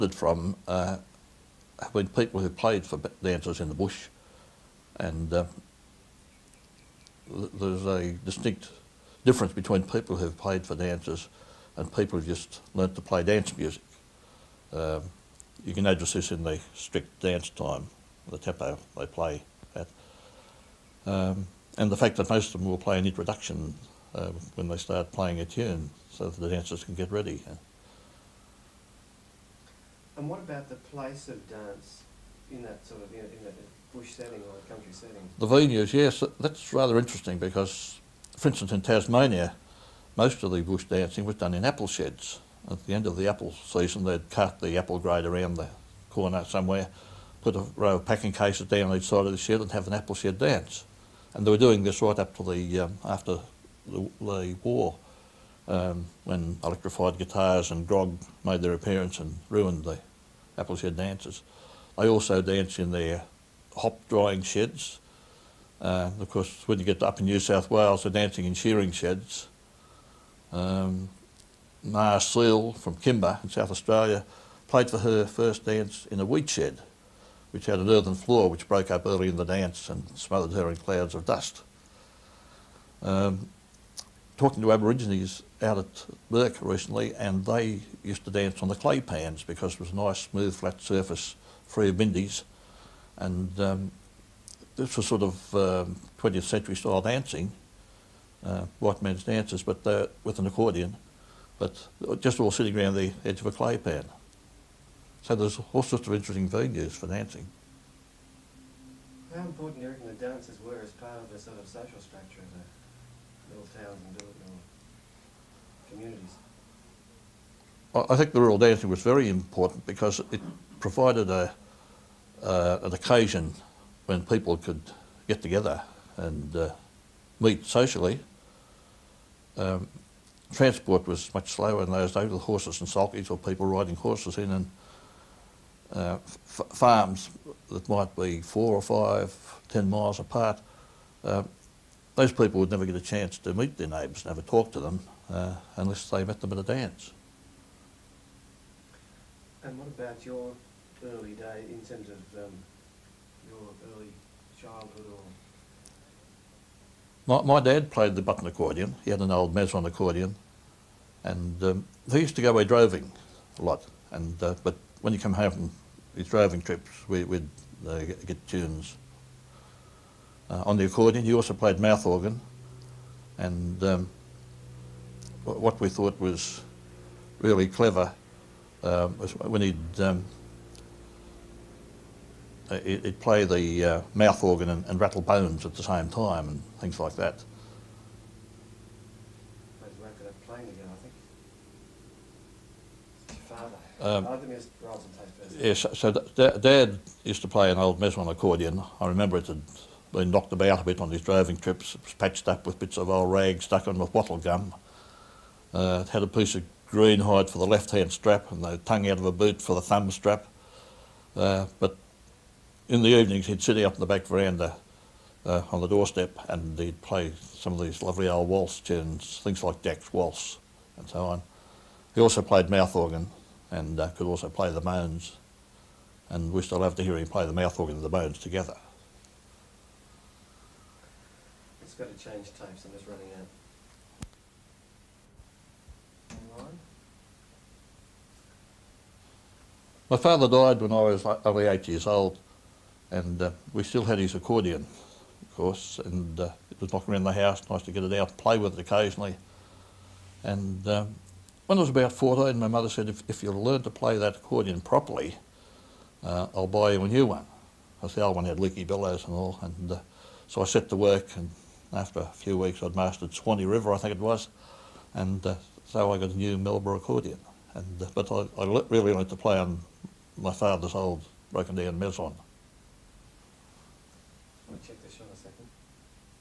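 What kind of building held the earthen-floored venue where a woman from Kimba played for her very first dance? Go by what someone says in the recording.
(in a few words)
Wheat shed.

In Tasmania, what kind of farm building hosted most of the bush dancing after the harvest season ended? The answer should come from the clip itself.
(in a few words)
Apple sheds.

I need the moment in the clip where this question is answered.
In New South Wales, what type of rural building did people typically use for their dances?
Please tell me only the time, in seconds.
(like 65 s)
68 s.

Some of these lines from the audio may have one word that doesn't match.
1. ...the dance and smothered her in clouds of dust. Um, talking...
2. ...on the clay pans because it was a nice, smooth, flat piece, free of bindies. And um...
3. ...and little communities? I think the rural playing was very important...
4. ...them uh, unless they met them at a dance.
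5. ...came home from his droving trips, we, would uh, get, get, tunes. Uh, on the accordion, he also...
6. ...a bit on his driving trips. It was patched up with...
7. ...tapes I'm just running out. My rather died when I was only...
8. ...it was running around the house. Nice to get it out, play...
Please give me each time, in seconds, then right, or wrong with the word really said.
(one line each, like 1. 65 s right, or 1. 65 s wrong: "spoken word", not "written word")
1. 79 s right
2. 88 s wrong: "surface", not "piece"
3. 114 s wrong: "dancing", not "playing"
4. 144 s right
5. 165 s right
6. 200 s right
7. 232 s wrong: "father", not "rather"
8. 246 s wrong: "knocking", not "running".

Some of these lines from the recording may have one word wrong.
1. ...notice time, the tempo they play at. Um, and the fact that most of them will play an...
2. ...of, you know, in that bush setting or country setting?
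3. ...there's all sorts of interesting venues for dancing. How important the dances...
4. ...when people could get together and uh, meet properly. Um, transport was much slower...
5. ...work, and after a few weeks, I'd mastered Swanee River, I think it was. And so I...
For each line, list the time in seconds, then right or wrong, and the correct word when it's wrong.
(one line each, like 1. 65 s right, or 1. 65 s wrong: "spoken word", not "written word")
1. 17 s wrong: "dance", not "notice"
2. 33 s right
3. 105 s right
4. 124 s wrong: "socially", not "properly"
5. 260 s right.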